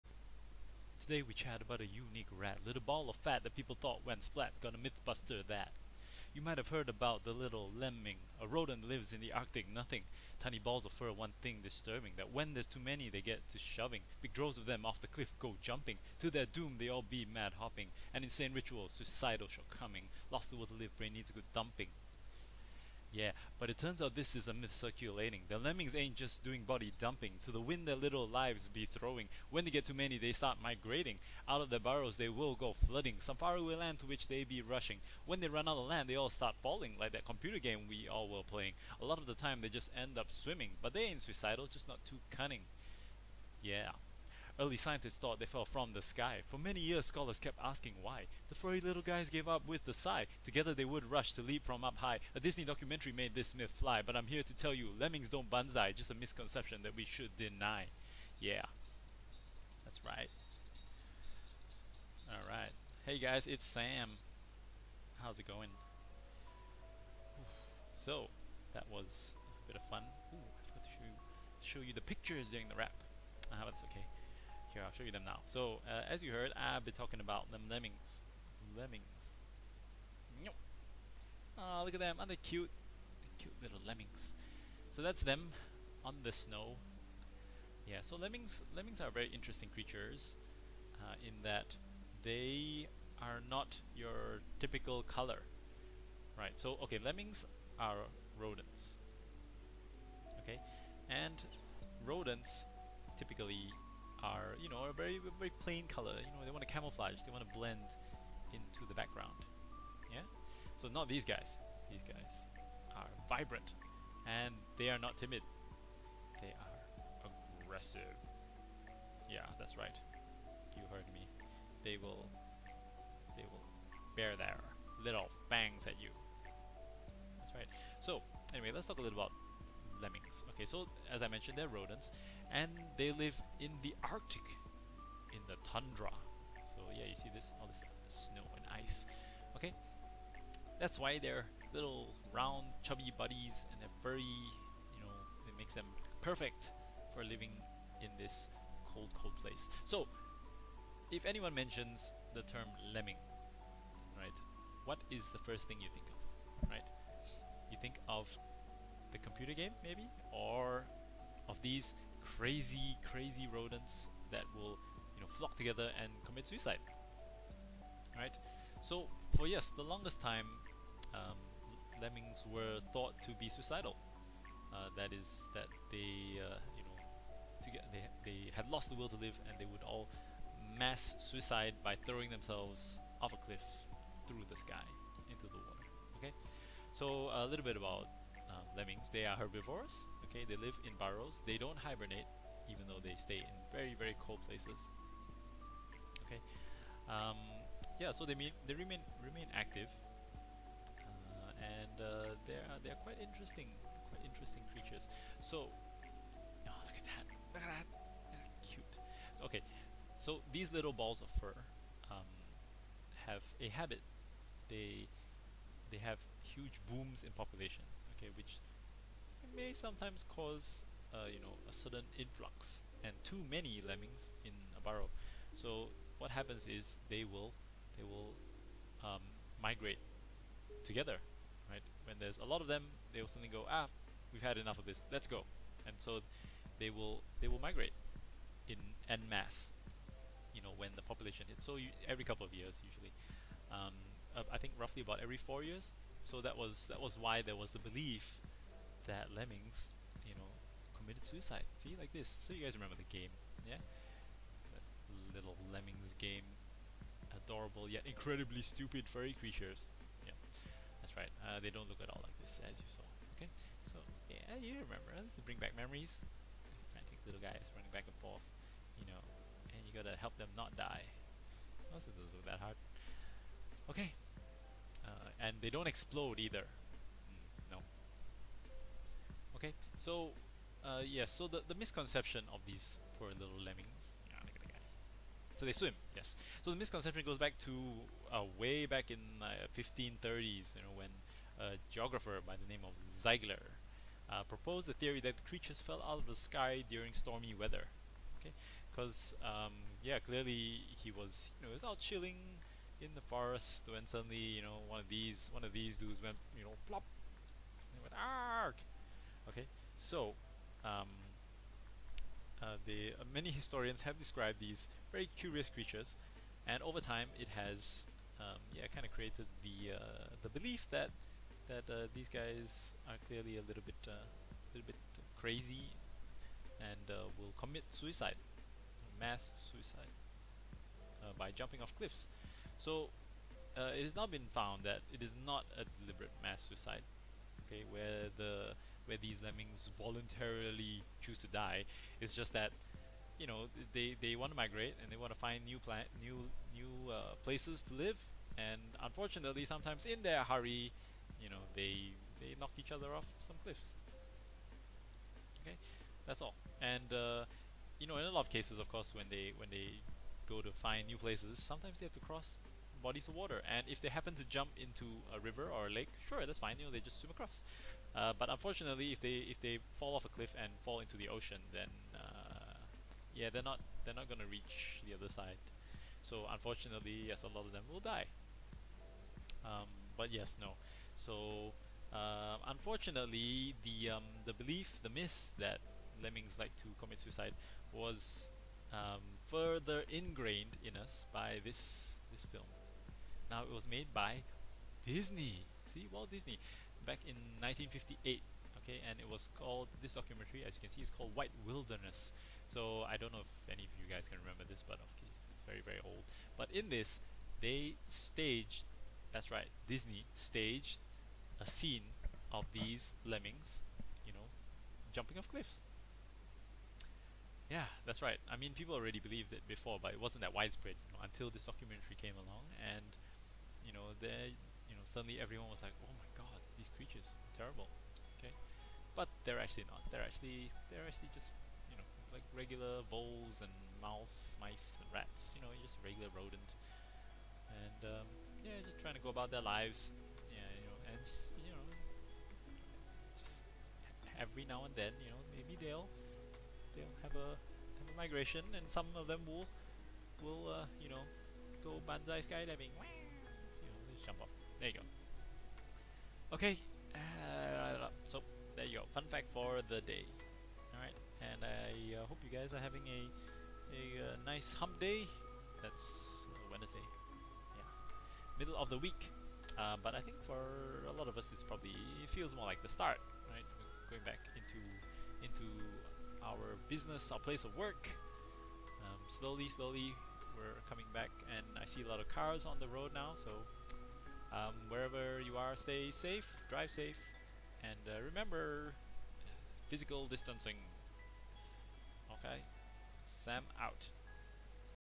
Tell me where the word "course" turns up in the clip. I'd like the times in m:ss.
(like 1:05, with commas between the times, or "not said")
5:58, 6:45.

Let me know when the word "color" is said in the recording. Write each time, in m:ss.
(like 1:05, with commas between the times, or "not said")
1:35, 1:45.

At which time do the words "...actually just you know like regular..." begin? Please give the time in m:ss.
7:11.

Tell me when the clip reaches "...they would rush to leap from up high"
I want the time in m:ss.
0:50.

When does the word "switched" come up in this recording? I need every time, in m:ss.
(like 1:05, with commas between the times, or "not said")
not said.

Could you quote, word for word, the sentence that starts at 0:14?
Big droves of them off the cliff go jumping, to their doom they all be mad hopping.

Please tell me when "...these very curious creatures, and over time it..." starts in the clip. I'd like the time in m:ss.
5:14.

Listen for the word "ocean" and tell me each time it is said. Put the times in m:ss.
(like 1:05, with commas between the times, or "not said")
6:11.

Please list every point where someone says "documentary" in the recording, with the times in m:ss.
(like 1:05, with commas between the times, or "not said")
0:52, 6:40, 7:01.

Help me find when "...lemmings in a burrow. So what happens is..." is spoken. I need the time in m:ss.
3:43.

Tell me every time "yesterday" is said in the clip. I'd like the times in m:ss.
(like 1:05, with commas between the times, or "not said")
not said.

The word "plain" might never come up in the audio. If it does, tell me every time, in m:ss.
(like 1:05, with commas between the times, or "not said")
1:45.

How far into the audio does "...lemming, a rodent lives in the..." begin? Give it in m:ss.
0:07.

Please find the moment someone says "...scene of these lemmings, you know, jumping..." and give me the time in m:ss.
6:51.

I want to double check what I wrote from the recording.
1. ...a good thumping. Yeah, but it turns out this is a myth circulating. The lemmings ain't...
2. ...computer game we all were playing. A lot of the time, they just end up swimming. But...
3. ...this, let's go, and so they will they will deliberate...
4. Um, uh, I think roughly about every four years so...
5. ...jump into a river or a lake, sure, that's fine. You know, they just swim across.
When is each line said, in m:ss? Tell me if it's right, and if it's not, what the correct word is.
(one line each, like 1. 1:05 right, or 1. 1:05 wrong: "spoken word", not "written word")
1. 0:21 right
2. 0:37 right
3. 3:54 wrong: "migrate", not "deliberate"
4. 4:03 right
5. 6:04 right.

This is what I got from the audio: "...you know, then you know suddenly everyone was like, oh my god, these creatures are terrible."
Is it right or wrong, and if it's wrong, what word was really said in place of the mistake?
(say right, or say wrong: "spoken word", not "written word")
right.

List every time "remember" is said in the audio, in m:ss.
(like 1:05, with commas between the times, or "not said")
4:12, 4:24, 6:44, 8:08.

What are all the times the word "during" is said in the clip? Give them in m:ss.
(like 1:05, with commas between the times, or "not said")
1:12, 4:56.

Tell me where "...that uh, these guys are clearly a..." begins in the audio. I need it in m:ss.
5:21.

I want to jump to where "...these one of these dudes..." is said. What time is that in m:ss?
5:05.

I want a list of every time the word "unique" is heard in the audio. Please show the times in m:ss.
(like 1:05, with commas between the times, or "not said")
0:01.